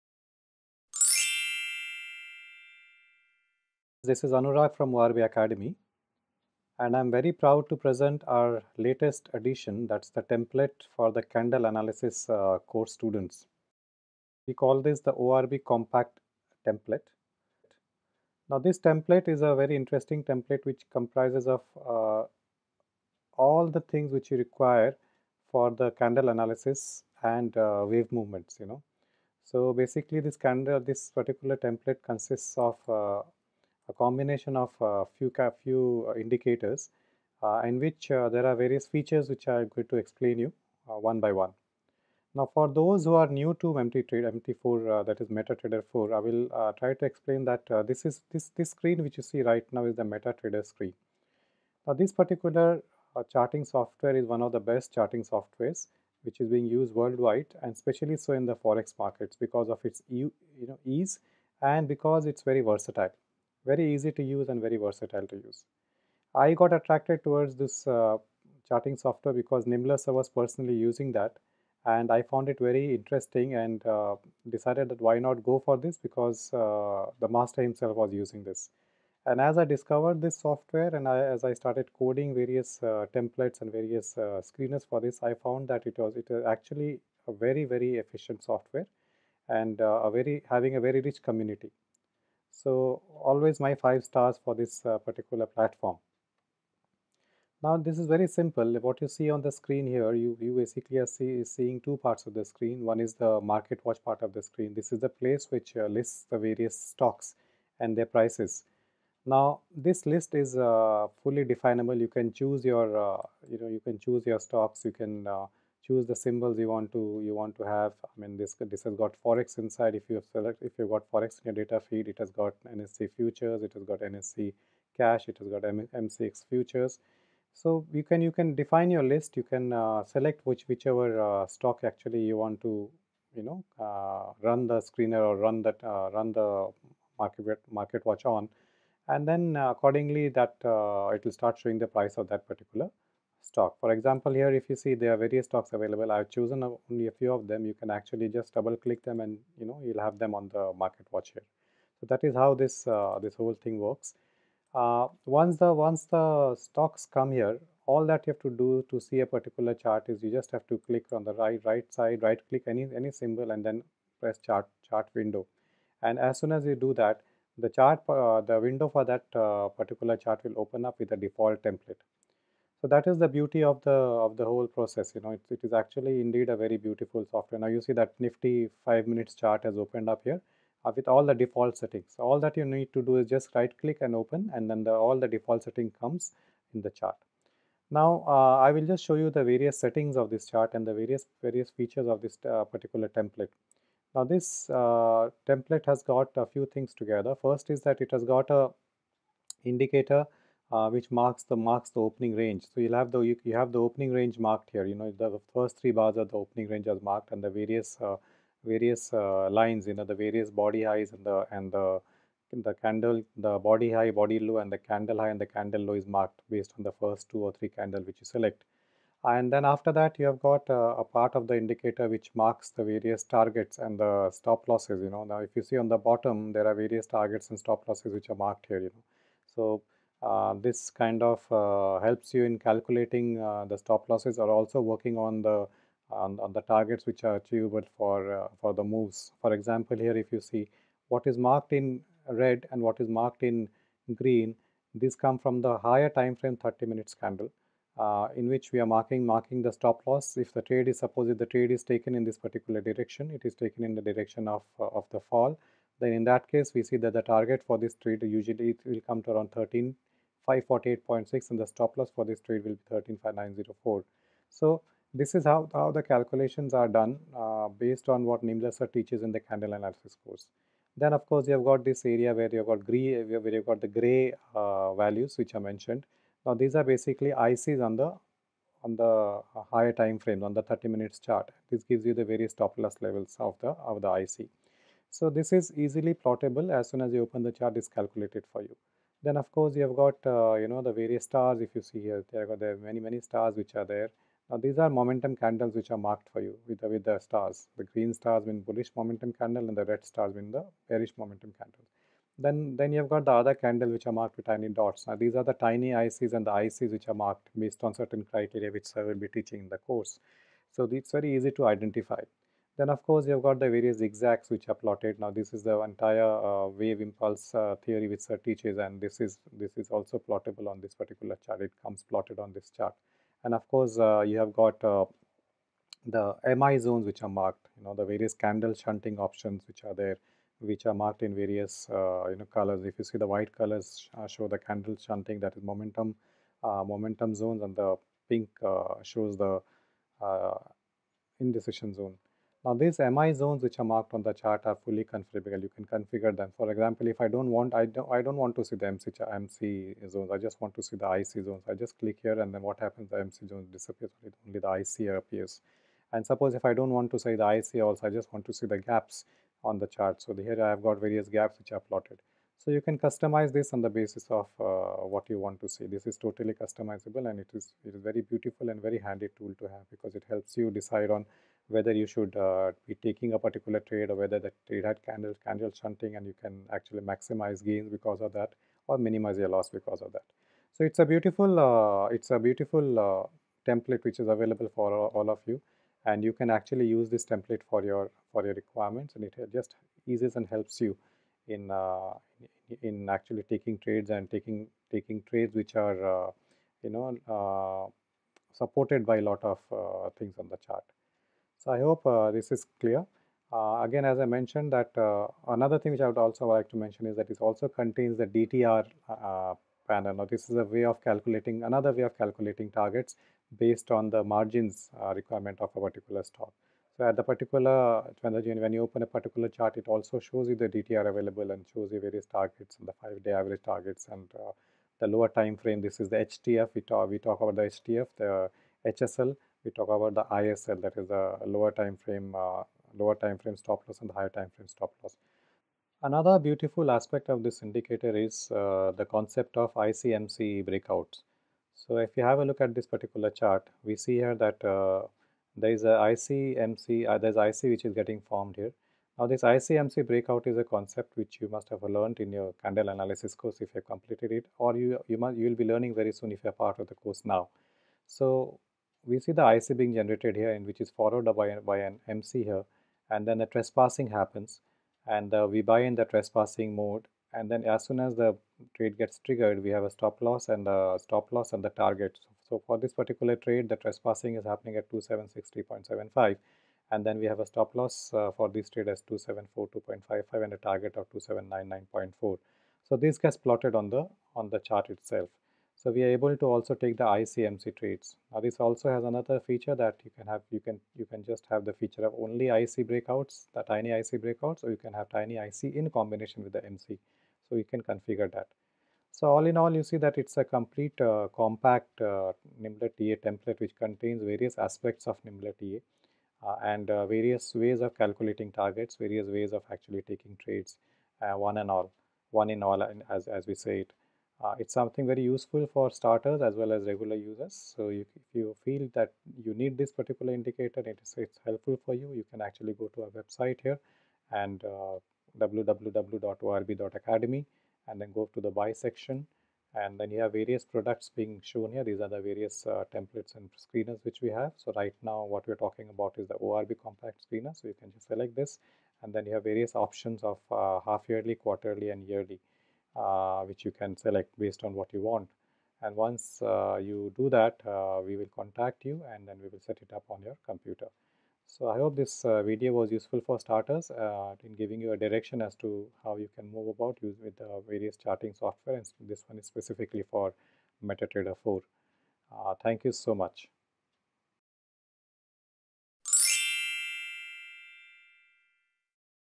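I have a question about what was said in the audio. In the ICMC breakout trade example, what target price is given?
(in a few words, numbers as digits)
2799.4.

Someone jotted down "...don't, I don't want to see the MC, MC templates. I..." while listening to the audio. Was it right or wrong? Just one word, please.
wrong.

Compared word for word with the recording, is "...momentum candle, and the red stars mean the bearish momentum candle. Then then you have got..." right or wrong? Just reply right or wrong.
right.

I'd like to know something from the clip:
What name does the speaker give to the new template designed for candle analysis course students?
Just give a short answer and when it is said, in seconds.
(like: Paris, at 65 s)
ORB compact template, at 15 s.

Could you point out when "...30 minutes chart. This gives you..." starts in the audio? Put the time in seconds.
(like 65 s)
280 s.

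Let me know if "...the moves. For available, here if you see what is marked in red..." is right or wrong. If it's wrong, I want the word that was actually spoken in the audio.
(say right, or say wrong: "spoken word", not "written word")
wrong: "example", not "available".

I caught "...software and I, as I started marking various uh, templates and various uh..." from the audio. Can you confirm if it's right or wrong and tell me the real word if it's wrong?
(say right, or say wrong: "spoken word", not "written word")
wrong: "coding", not "marking".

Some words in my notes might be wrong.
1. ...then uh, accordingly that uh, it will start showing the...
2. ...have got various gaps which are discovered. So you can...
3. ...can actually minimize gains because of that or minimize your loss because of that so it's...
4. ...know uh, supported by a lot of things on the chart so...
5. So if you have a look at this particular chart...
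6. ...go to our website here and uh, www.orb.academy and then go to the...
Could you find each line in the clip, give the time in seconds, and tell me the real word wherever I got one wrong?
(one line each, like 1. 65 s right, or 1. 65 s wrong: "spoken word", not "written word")
1. 139 s right
2. 360 s wrong: "plotted", not "discovered"
3. 376 s wrong: "maximize", not "minimize"
4. 396 s right
5. 441 s right
6. 522 s right.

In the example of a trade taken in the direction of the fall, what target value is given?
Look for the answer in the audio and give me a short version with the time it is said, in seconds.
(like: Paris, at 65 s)
13548.6, at 259 s.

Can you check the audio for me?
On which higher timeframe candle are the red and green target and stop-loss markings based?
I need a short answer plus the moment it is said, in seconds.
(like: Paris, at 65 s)
30 minutes, at 246 s.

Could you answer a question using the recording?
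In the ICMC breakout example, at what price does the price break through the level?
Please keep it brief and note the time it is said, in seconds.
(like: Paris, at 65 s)
2760.75, at 474 s.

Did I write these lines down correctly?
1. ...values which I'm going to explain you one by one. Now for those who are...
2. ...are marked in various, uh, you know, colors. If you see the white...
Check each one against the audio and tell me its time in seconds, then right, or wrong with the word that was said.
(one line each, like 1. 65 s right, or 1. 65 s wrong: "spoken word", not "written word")
1. 38 s wrong: "features", not "values"
2. 330 s right.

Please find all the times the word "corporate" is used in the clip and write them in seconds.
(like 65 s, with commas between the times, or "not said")
not said.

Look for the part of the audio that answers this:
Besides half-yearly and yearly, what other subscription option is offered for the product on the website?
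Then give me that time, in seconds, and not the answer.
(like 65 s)
541 s.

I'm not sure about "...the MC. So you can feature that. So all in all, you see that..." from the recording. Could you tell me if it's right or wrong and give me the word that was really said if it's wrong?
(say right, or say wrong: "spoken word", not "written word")
wrong: "configure", not "feature".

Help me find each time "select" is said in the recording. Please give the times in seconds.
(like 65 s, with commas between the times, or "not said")
120 s, 130 s, 218 s, 538 s, 543 s.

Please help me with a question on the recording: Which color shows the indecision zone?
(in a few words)
Pink.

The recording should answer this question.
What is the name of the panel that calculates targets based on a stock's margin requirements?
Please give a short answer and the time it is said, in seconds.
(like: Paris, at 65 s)
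DTR panel, at 408 s.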